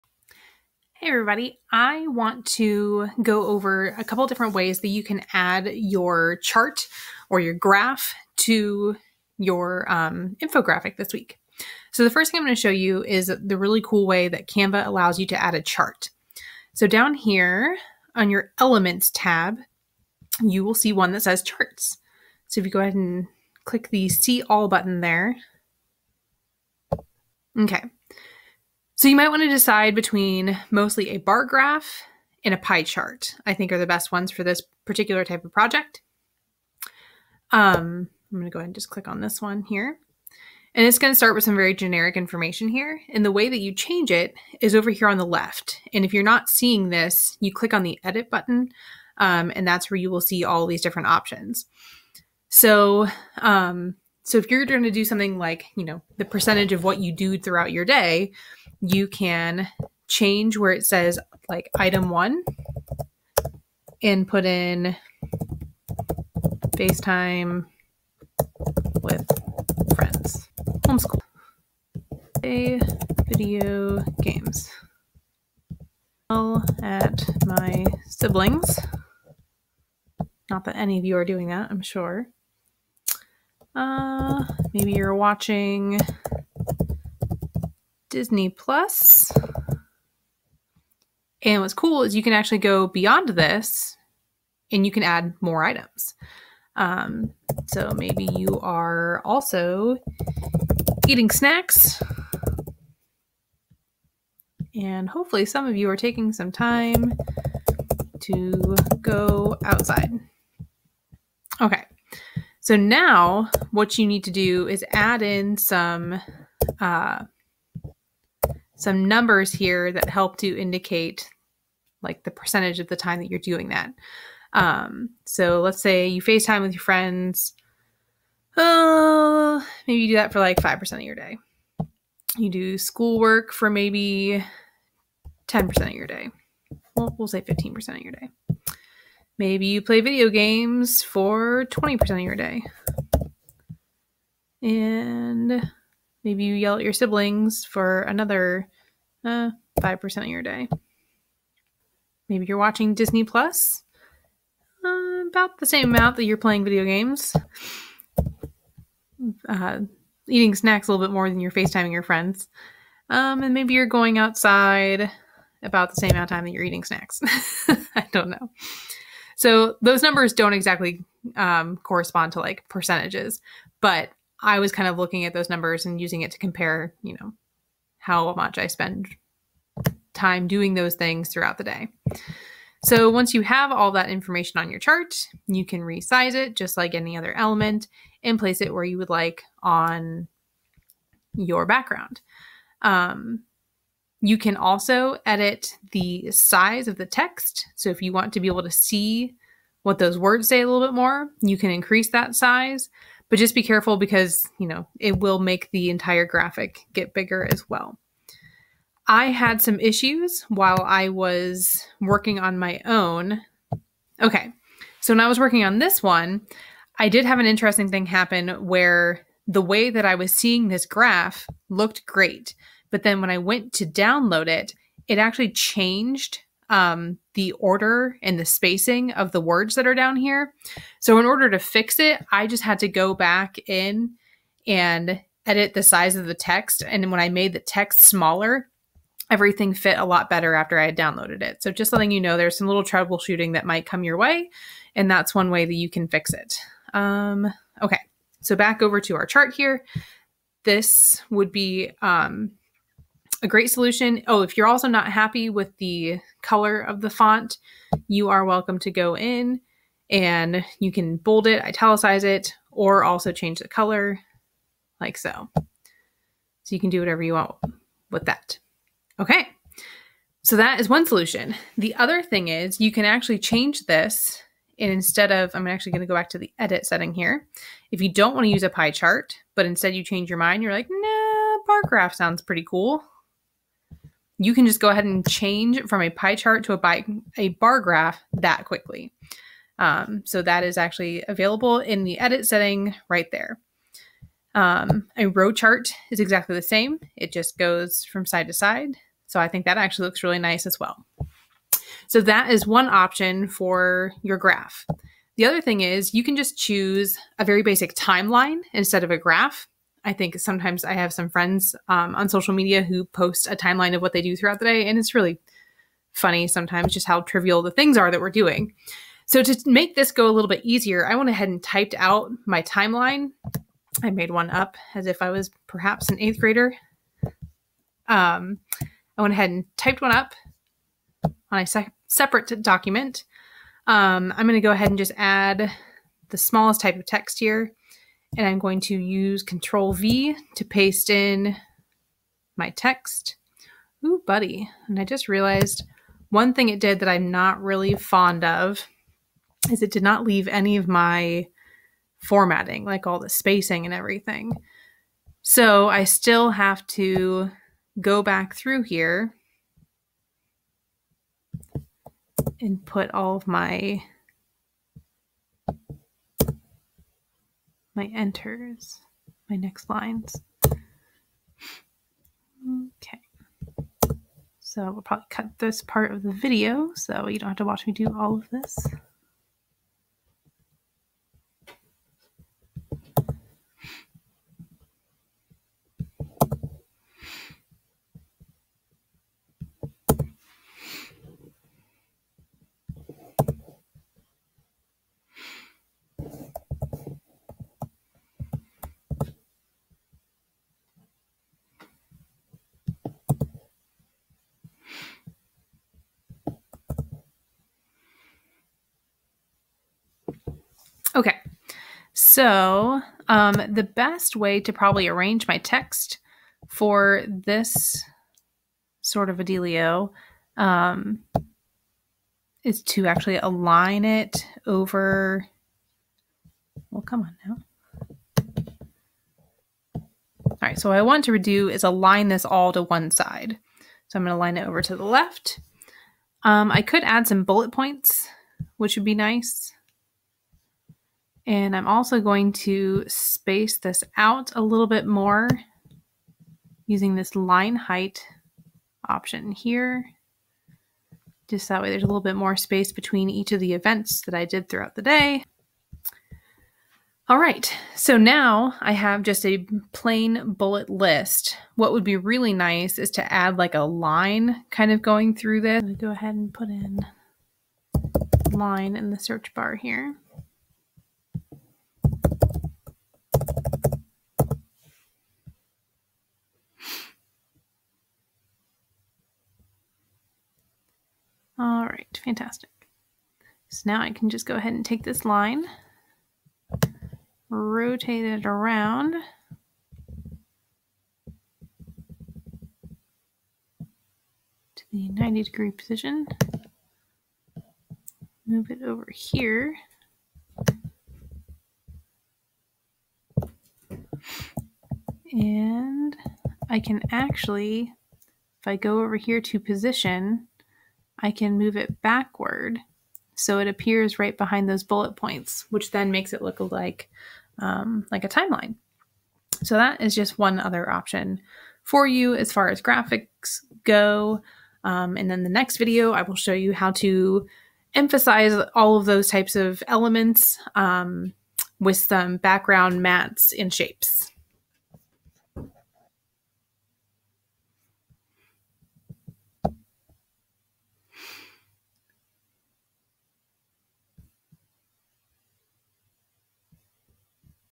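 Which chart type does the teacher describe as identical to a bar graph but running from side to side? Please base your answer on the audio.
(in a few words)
row chart.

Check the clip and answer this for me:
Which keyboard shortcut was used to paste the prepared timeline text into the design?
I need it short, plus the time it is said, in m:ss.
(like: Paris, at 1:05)
Control V, at 5:39.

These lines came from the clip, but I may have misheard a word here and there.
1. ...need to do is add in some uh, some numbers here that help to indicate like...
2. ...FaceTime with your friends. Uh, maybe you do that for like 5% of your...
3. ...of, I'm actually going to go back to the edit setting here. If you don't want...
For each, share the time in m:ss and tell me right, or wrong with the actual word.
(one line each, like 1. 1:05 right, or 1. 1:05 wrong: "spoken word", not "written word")
1. 1:54 right
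2. 2:06 right
3. 4:35 right.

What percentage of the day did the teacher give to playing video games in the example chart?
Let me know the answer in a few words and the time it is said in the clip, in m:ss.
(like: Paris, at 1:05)
20%, at 2:21.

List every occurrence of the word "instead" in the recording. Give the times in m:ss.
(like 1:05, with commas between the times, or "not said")
4:34, 4:39, 5:08.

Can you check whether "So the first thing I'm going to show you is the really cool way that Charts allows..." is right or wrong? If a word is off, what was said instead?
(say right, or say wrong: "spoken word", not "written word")
wrong: "Canva", not "Charts".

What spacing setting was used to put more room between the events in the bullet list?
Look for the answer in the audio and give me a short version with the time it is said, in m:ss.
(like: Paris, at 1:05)
line height, at 7:27.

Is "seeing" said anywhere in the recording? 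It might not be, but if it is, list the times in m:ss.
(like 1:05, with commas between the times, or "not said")
0:46, 3:40.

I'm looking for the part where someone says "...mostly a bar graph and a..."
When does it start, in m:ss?
0:30.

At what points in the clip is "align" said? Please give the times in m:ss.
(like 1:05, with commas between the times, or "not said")
7:03, 7:11.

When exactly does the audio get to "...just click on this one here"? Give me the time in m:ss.
0:38.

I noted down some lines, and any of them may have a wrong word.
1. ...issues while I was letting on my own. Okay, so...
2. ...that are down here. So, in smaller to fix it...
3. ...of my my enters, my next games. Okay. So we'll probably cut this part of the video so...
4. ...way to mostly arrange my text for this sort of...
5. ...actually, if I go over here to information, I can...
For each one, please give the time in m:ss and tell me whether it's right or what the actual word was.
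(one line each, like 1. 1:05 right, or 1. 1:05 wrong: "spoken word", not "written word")
1. 3:29 wrong: "working", not "letting"
2. 3:49 wrong: "order", not "smaller"
3. 6:03 wrong: "lines", not "games"
4. 6:54 wrong: "probably", not "mostly"
5. 8:27 wrong: "position", not "information".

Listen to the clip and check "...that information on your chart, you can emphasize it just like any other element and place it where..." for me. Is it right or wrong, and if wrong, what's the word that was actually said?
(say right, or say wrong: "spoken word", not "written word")
wrong: "resize", not "emphasize".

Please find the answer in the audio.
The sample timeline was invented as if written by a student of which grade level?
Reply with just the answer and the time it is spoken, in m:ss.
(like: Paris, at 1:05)
eighth grader, at 5:26.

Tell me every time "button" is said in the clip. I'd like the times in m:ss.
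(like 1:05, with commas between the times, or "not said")
0:24, 0:48.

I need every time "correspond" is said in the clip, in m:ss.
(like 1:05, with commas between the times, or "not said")
2:51.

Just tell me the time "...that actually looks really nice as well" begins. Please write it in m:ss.
4:59.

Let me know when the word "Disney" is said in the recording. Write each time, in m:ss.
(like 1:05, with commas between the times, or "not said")
1:28, 2:32.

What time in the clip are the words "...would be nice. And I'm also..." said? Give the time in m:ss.
7:18.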